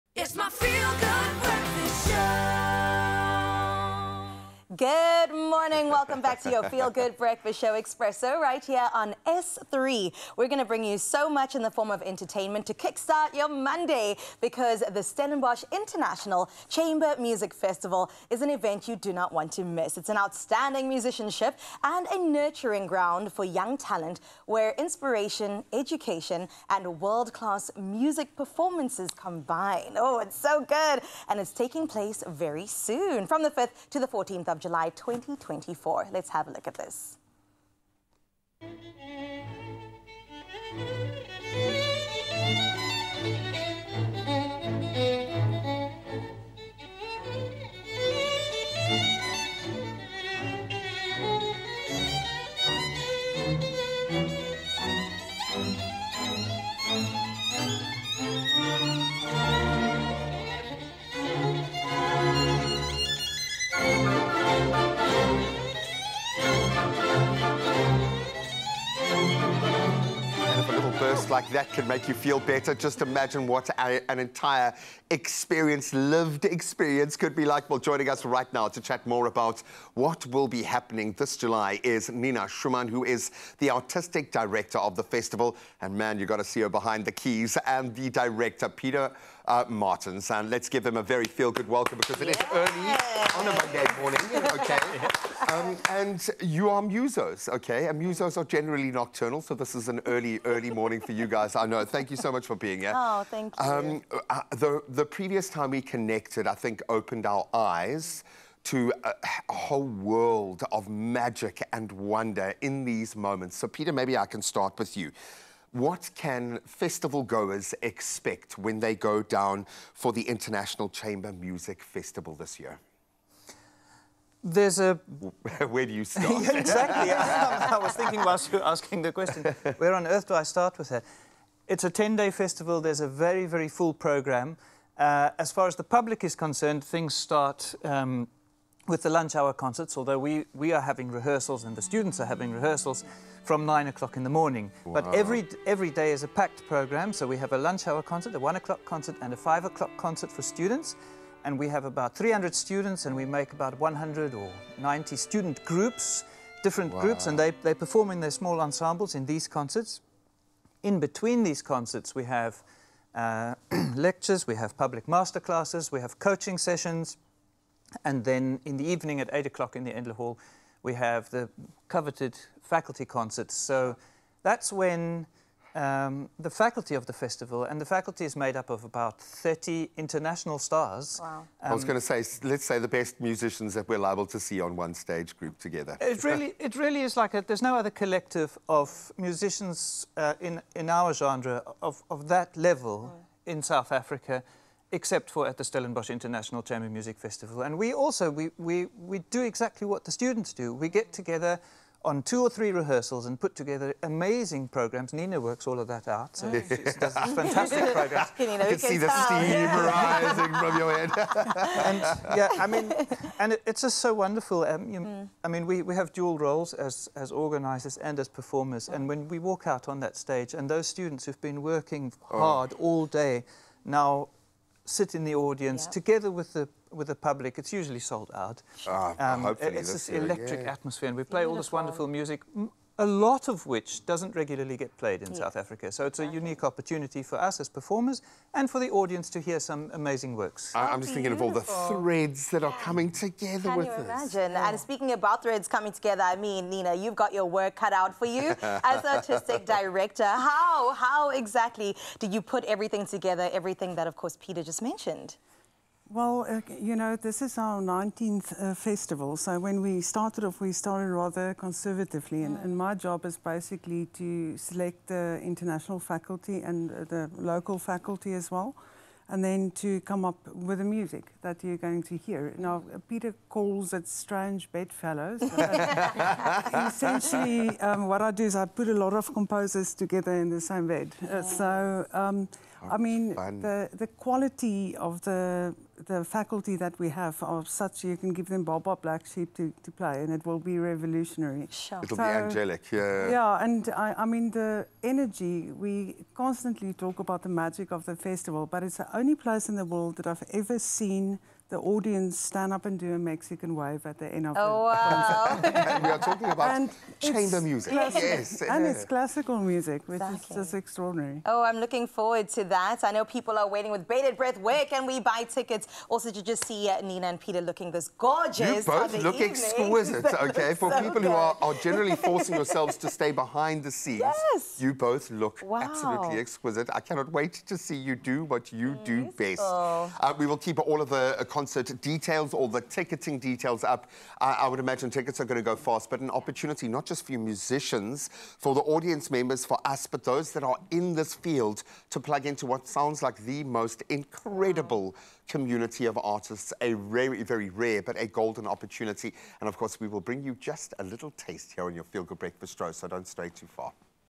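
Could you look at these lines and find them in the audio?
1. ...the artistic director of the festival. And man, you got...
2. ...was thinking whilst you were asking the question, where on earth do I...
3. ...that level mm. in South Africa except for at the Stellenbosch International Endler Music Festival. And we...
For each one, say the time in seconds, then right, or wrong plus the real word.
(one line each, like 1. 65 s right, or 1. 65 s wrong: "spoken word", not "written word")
1. 83 s right
2. 127 s right
3. 192 s wrong: "Chamber", not "Endler".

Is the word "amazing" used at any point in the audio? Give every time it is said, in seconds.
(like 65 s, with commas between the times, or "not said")
204 s, 239 s.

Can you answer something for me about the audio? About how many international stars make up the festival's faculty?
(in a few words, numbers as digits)
30.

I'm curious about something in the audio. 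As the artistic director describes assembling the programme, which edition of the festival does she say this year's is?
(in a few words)
19th.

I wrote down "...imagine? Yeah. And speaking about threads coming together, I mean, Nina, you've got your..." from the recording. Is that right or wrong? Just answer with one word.
right.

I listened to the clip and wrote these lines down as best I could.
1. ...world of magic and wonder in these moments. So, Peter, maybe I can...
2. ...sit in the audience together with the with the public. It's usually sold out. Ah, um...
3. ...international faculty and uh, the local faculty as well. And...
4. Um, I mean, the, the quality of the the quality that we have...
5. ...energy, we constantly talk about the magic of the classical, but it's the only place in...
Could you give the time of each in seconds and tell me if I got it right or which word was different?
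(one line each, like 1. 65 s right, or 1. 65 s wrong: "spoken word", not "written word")
1. 109 s right
2. 224 s right
3. 265 s right
4. 282 s wrong: "faculty", not "quality"
5. 295 s wrong: "festival", not "classical".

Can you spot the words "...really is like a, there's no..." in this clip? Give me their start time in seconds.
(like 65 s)
186 s.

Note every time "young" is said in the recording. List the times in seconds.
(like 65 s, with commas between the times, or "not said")
23 s.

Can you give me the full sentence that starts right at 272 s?
Now, Peter calls it strange bedfellows.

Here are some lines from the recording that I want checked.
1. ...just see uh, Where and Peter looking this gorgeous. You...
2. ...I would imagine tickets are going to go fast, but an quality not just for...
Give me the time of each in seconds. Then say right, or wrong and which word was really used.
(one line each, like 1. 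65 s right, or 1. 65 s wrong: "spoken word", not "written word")
1. 316 s wrong: "Nina", not "Where"
2. 334 s wrong: "opportunity", not "quality".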